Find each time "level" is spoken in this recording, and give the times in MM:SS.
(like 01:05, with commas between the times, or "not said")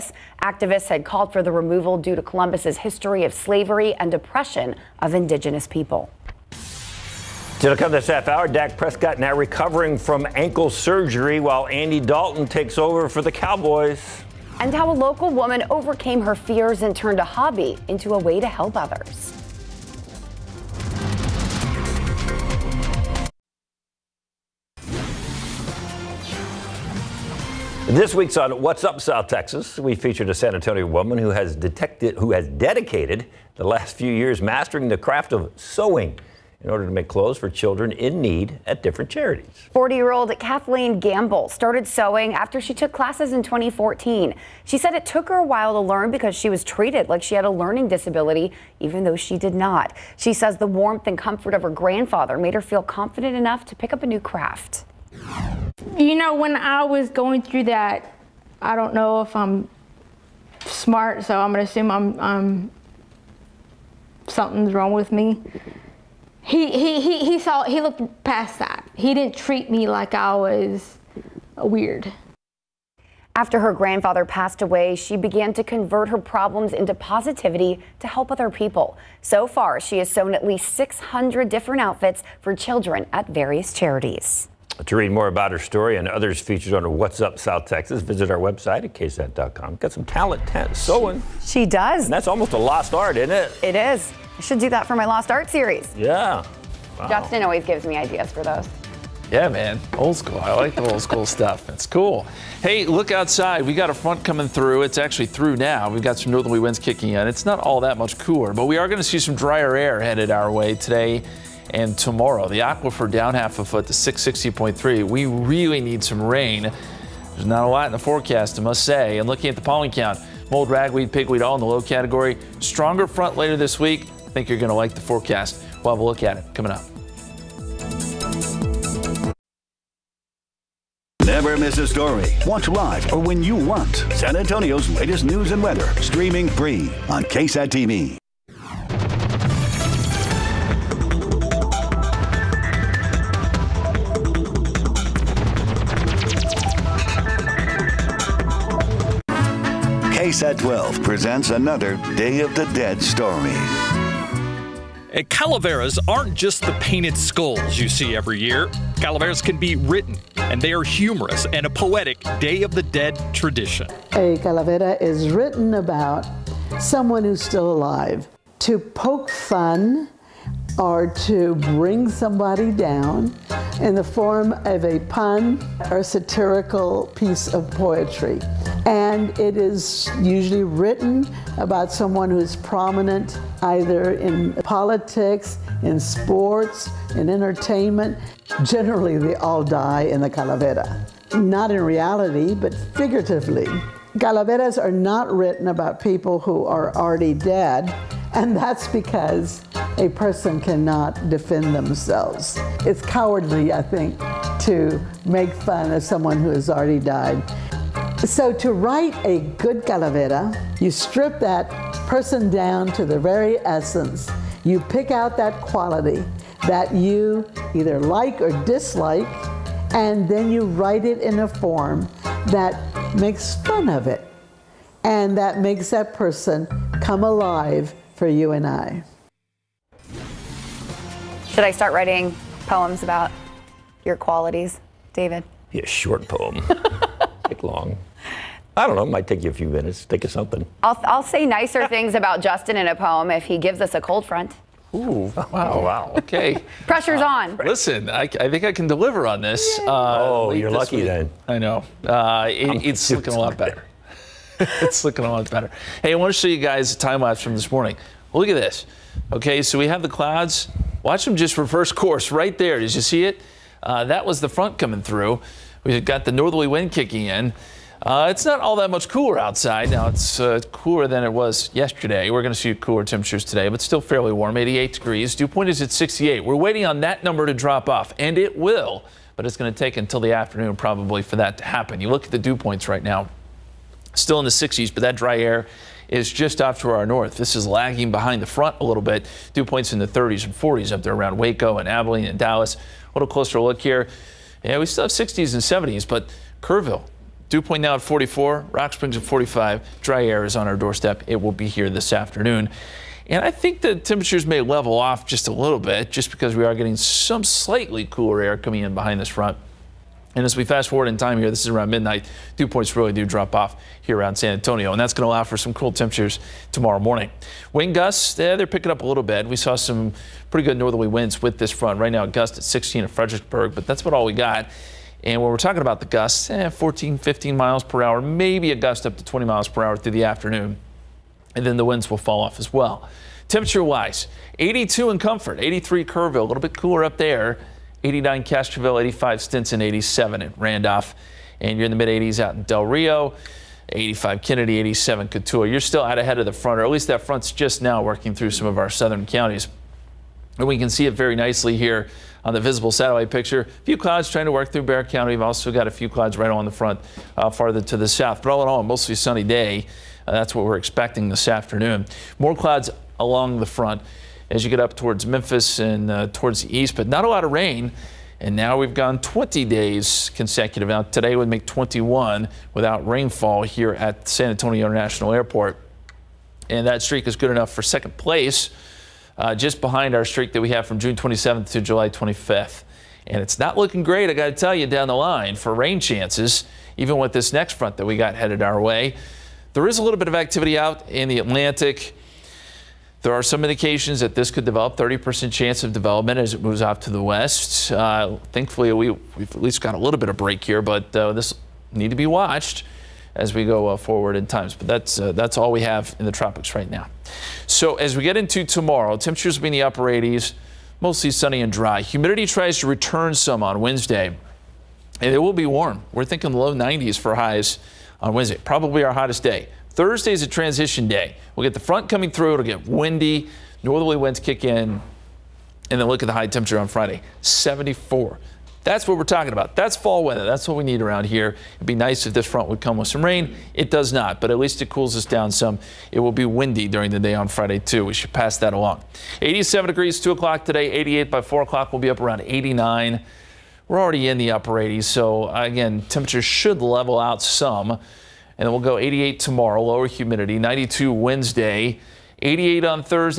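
05:04, 07:26.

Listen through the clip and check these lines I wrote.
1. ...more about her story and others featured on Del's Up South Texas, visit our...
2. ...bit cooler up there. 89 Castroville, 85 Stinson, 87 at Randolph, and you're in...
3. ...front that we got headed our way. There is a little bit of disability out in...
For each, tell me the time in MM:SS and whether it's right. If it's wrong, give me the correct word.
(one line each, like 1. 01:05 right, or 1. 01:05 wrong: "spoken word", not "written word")
1. 01:25 wrong: "What", not "Del"
2. 05:36 right
3. 06:27 wrong: "activity", not "disability".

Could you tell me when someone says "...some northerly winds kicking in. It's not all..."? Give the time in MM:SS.
01:46.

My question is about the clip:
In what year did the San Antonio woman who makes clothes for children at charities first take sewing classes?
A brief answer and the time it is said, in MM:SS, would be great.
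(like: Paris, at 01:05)
2014, at 00:43.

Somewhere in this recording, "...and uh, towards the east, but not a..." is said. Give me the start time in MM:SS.
06:05.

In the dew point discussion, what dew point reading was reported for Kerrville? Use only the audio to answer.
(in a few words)
44.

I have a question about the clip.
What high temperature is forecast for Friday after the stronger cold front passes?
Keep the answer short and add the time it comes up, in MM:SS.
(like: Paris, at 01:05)
74, at 07:07.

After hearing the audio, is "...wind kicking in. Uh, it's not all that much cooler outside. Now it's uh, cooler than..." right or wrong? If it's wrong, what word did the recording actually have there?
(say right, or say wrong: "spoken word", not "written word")
right.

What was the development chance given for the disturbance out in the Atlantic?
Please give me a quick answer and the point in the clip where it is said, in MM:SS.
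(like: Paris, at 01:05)
30%, at 06:34.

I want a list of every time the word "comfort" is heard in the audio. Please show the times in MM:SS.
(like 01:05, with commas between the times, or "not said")
00:51, 05:35.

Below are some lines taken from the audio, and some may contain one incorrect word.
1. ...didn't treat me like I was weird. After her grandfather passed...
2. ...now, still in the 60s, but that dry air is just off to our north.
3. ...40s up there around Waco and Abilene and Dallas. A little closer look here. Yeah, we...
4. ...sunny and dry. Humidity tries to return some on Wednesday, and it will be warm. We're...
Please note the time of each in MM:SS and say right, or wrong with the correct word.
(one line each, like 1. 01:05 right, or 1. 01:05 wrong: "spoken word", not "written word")
1. 01:09 right
2. 04:43 right
3. 04:50 right
4. 06:51 right.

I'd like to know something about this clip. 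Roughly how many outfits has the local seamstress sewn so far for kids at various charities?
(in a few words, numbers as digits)
600.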